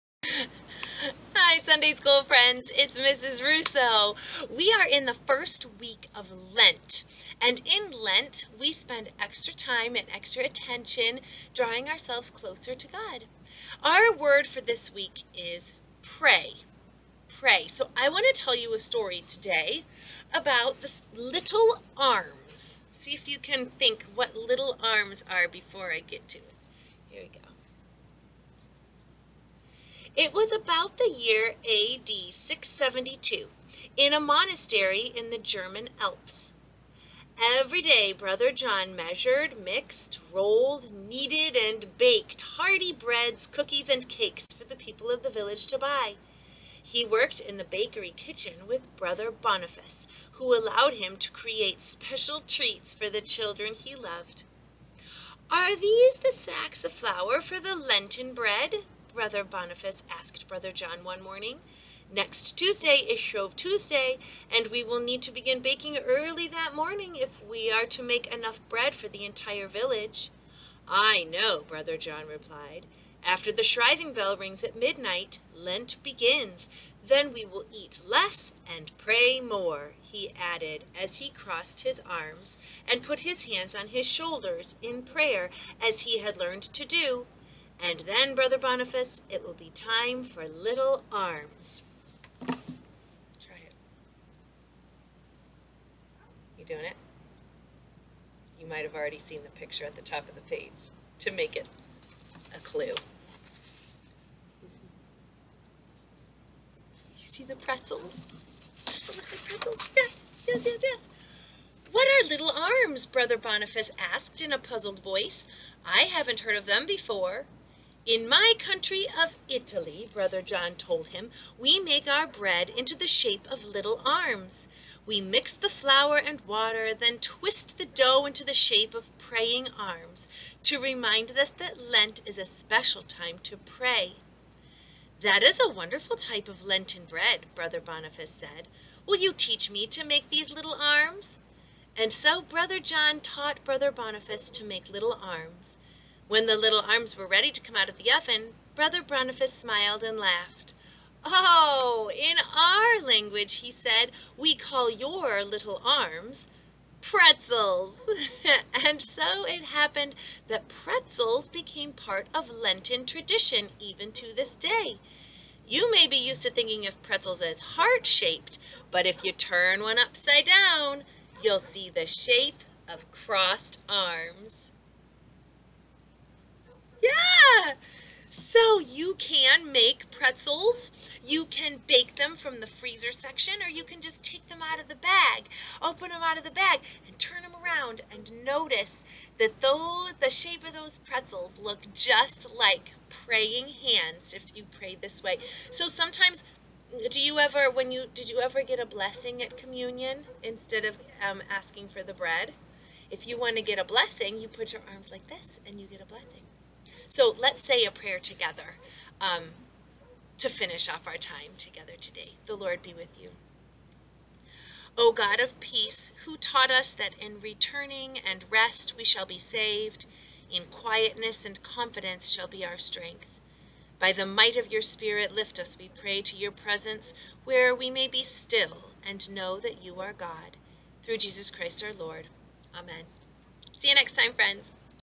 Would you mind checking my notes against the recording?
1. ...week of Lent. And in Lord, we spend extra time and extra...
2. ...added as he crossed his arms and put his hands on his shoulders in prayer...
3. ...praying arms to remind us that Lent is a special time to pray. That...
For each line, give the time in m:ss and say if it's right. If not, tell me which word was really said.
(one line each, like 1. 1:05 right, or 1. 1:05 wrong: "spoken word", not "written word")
1. 0:05 wrong: "Lent", not "Lord"
2. 1:20 right
3. 2:09 right.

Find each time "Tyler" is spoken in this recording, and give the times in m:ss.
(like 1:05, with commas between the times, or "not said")
not said.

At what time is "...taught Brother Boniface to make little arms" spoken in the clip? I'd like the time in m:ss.
2:23.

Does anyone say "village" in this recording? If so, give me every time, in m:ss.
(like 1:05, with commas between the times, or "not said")
0:45, 1:09.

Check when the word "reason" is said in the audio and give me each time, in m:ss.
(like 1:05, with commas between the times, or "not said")
not said.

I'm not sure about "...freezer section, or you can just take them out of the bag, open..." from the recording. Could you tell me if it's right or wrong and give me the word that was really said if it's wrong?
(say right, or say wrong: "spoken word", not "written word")
right.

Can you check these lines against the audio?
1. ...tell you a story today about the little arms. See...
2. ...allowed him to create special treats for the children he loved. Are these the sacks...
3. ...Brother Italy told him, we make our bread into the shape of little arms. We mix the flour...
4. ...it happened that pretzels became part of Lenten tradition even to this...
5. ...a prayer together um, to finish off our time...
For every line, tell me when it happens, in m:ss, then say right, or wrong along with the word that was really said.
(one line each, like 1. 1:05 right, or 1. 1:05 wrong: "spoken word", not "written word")
1. 0:18 right
2. 0:50 right
3. 2:00 wrong: "John", not "Italy"
4. 2:39 right
5. 3:27 right.